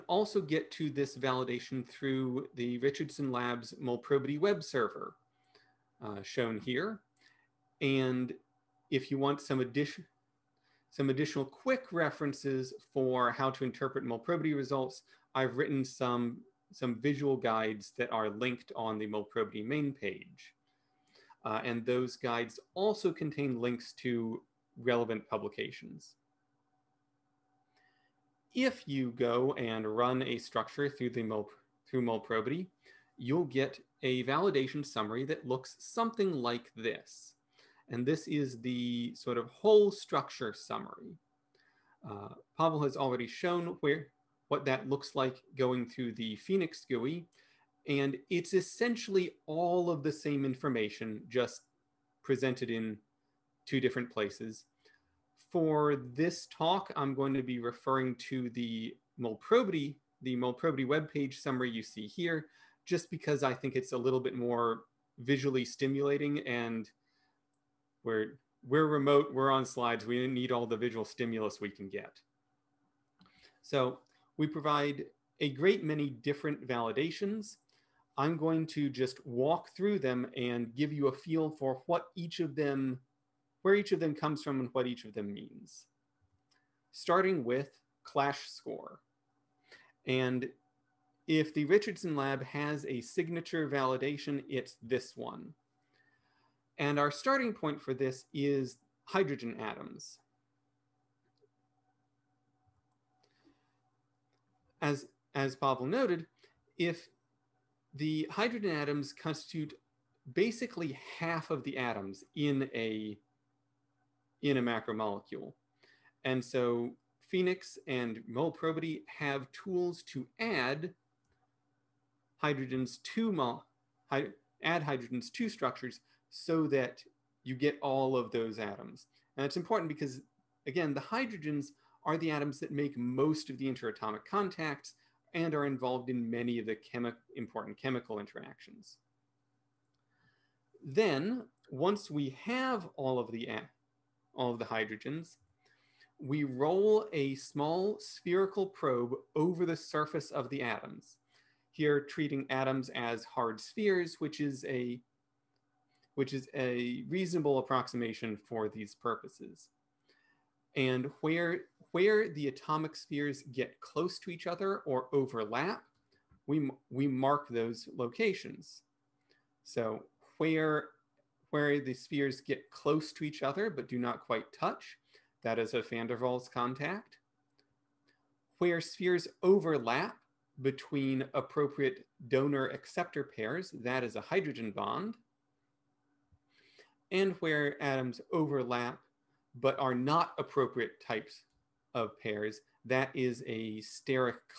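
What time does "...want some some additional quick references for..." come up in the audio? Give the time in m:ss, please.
0:09.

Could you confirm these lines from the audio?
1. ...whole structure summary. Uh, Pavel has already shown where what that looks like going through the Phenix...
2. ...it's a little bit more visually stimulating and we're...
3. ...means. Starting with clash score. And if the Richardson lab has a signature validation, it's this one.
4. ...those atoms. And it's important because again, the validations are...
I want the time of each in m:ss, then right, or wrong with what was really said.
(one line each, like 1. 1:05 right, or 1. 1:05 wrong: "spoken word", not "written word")
1. 0:39 right
2. 1:03 right
3. 1:25 right
4. 2:08 wrong: "hydrogens", not "validations".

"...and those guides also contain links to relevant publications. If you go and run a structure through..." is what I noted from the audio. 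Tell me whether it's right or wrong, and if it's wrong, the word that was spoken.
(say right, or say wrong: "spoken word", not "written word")
right.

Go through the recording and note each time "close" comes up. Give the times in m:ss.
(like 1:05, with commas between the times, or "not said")
2:43, 2:52.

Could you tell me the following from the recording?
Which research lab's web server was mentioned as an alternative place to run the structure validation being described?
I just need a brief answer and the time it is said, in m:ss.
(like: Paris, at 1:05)
Richardson Labs, at 0:02.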